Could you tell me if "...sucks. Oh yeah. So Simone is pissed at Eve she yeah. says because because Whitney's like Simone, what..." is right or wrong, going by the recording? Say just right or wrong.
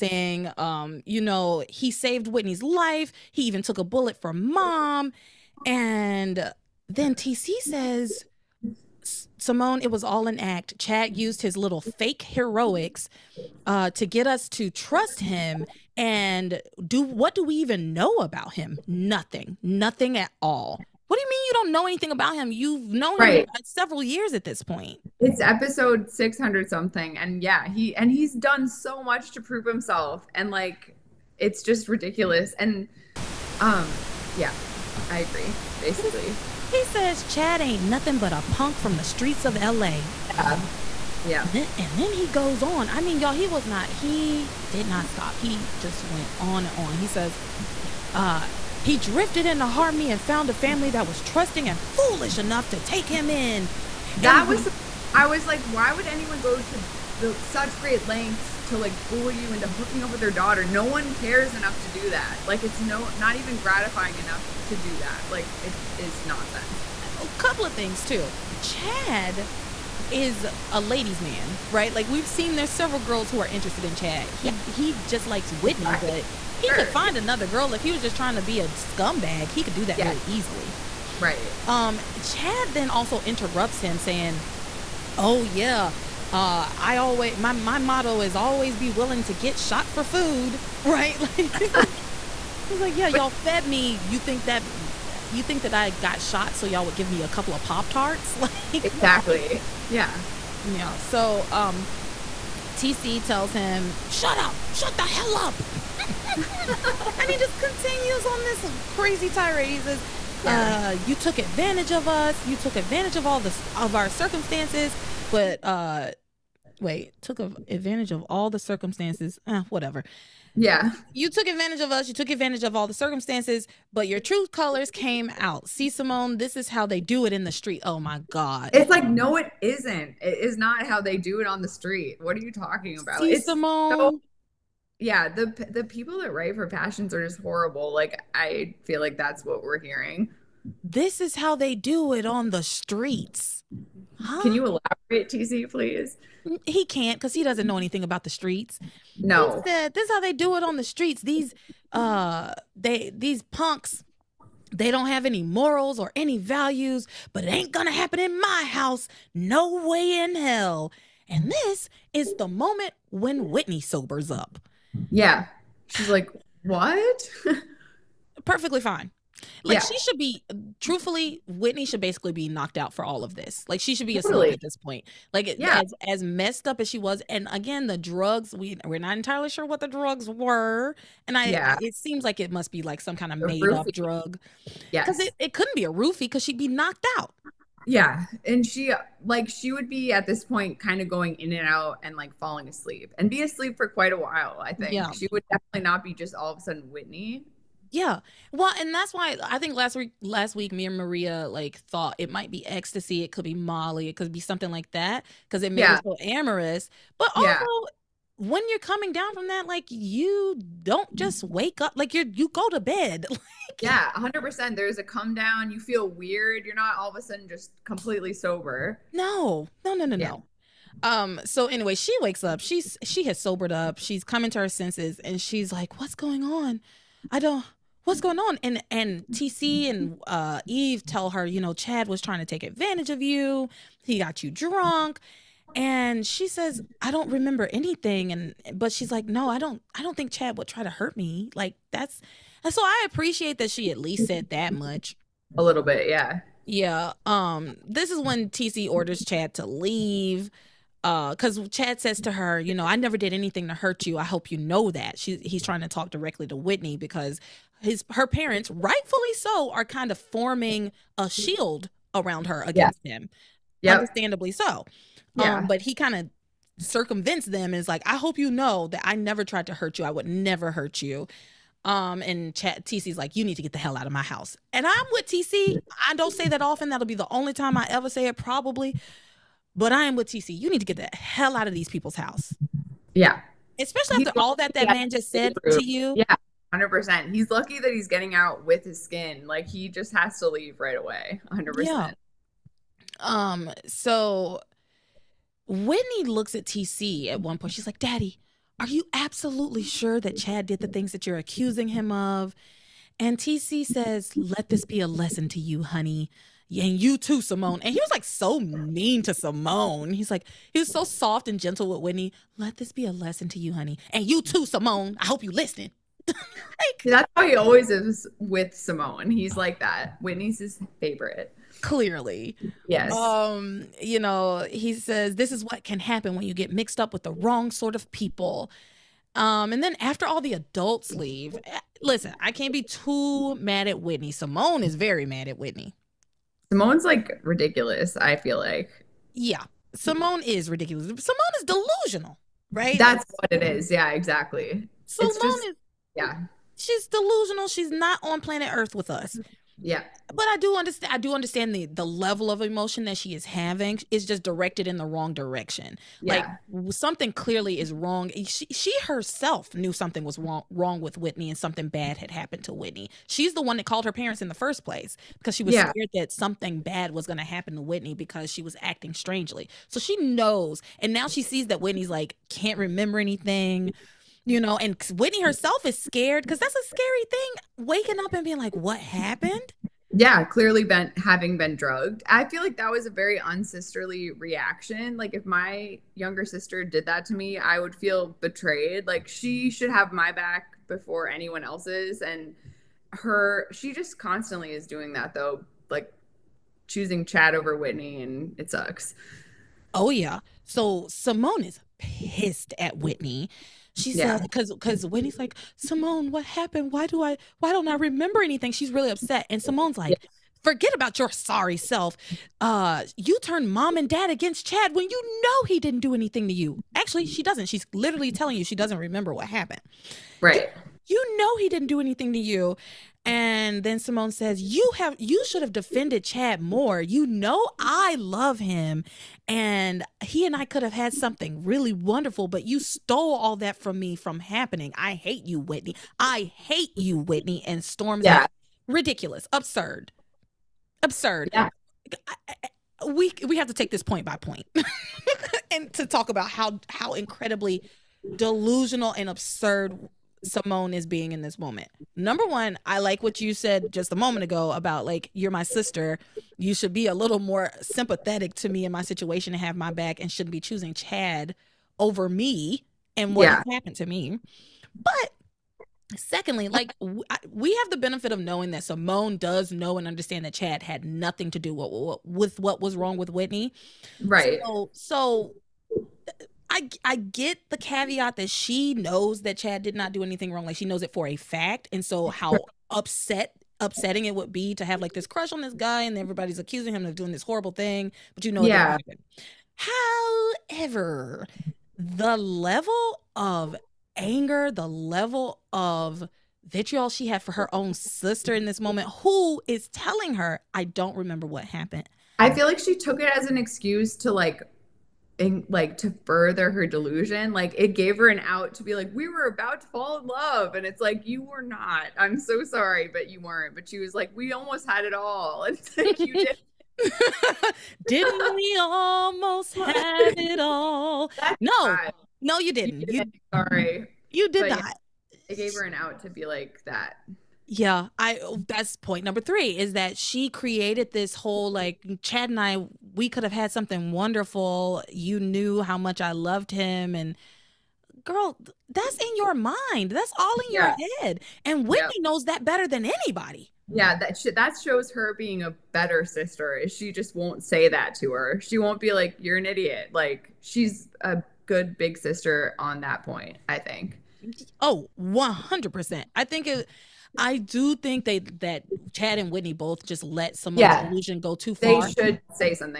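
wrong.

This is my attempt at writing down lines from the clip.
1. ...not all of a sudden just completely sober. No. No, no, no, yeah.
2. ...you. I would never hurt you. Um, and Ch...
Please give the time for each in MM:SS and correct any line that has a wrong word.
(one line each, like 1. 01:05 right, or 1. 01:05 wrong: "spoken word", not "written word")
1. 03:36 right
2. 04:29 right.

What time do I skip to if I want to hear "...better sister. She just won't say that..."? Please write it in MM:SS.
09:05.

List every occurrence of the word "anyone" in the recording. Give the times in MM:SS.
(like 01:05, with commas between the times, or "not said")
00:56, 06:31.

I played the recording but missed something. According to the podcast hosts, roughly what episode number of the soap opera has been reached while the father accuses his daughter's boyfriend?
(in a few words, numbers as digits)
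600 something.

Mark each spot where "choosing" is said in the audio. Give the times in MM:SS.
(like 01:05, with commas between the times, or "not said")
06:36, 07:40.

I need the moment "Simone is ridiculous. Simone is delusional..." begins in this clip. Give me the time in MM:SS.
05:39.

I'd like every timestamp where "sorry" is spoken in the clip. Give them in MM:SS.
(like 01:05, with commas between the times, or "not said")
06:51, 08:32, 08:43.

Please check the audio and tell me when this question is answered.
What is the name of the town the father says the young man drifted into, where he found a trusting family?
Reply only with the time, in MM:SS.
00:49.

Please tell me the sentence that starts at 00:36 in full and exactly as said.
He says Chad ain't nothing but a punk from the streets of LA.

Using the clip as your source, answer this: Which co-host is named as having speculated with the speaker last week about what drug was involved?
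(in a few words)
Maria.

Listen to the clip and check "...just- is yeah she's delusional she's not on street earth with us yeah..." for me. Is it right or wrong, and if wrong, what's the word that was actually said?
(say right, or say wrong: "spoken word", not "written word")
wrong: "planet", not "street".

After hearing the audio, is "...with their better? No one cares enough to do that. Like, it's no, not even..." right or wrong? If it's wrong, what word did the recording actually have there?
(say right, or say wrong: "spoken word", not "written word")
wrong: "daughter", not "better".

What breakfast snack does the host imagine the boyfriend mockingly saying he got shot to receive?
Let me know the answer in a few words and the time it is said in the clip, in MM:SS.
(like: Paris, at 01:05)
pop tarts, at 01:37.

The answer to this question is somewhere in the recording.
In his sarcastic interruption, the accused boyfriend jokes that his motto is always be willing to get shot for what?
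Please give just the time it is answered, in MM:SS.
01:30.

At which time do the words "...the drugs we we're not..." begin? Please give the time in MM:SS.
02:57.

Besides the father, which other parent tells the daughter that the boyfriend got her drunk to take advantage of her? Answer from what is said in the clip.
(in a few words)
Eve.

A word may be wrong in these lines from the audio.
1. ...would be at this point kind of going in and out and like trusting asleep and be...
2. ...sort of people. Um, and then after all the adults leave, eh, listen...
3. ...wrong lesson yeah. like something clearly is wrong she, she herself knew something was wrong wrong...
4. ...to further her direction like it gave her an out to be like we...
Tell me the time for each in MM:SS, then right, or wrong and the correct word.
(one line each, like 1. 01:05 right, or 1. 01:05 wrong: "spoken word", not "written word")
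1. 03:09 wrong: "falling", not "trusting"
2. 05:27 right
3. 05:55 wrong: "direction", not "lesson"
4. 08:25 wrong: "delusion", not "direction".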